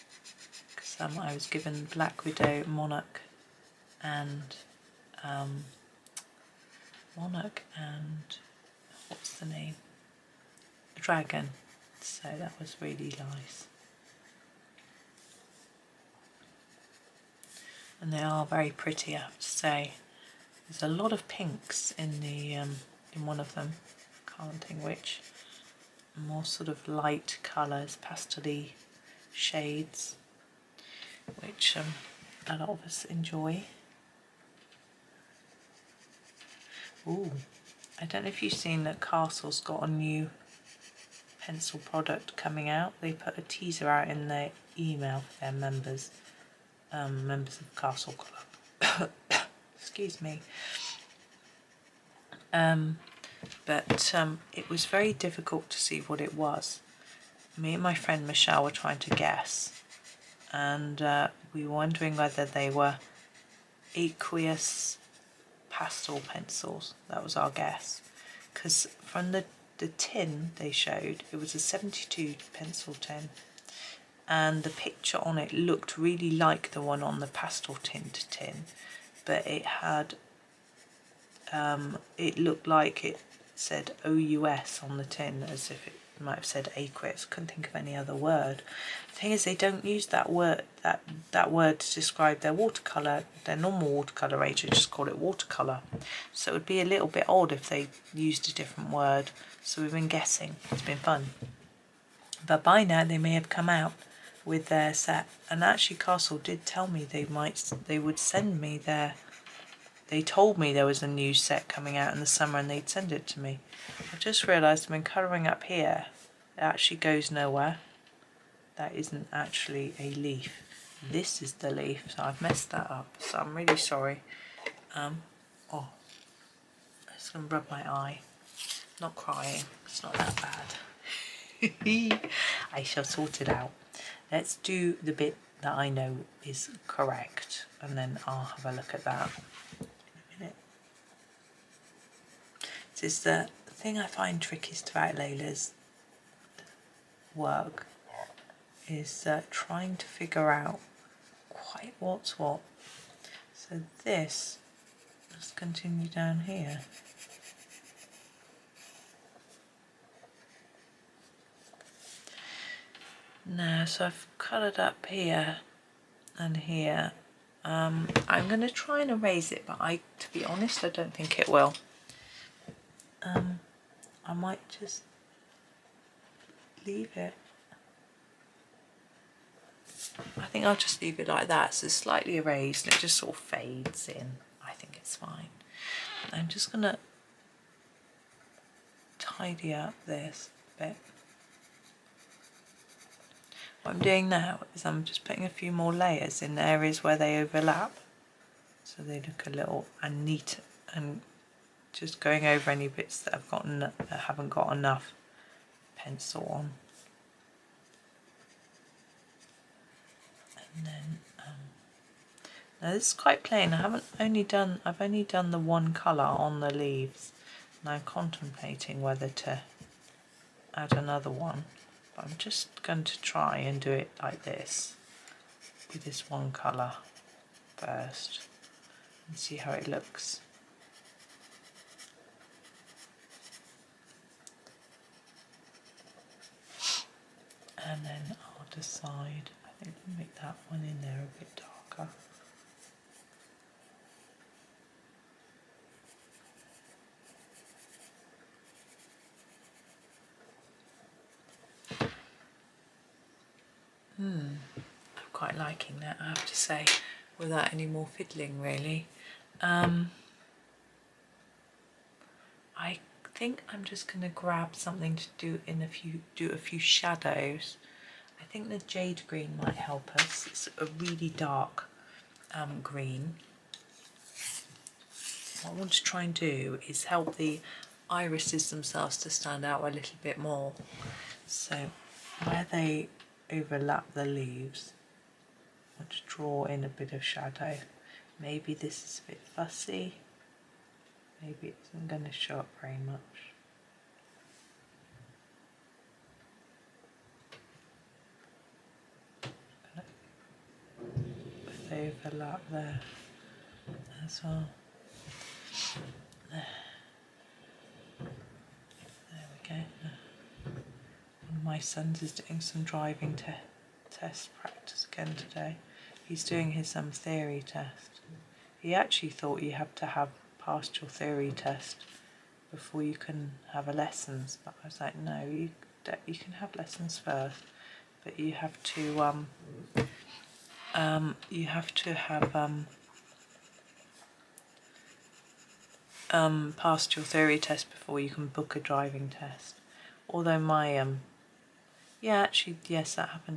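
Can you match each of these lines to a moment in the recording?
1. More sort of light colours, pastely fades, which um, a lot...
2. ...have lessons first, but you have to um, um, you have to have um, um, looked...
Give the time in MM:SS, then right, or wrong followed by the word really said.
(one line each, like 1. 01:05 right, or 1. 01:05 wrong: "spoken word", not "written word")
1. 00:26 wrong: "shades", not "fades"
2. 05:26 wrong: "passed", not "looked".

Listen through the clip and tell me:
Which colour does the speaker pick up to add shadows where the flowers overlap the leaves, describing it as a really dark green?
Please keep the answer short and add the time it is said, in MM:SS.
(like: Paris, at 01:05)
jade green, at 04:28.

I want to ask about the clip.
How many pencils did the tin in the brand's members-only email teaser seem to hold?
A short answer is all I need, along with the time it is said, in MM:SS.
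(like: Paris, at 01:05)
72, at 01:11.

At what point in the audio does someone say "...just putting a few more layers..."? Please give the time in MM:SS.
03:15.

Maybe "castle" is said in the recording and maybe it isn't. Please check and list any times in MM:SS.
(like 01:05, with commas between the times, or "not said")
00:39, 00:47, 01:45.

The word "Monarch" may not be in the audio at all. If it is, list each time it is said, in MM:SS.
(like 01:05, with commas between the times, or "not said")
00:02, 00:07.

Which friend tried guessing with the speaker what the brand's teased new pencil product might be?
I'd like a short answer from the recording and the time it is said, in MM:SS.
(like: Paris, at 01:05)
Michelle, at 00:58.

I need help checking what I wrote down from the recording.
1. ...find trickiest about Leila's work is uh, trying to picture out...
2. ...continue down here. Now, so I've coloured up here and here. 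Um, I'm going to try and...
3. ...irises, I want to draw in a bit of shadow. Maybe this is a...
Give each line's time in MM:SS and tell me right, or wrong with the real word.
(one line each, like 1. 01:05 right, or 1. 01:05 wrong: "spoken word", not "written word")
1. 02:24 wrong: "figure", not "picture"
2. 02:35 right
3. 04:44 wrong: "leaves", not "irises".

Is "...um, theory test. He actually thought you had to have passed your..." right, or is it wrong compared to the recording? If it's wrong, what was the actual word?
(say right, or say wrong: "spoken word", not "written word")
right.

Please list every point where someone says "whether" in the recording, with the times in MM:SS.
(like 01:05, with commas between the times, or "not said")
01:02, 03:39.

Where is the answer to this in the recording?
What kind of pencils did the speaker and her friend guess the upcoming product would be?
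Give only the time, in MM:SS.
01:03.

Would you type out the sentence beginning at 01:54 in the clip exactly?
I've just realised I've been colouring up here.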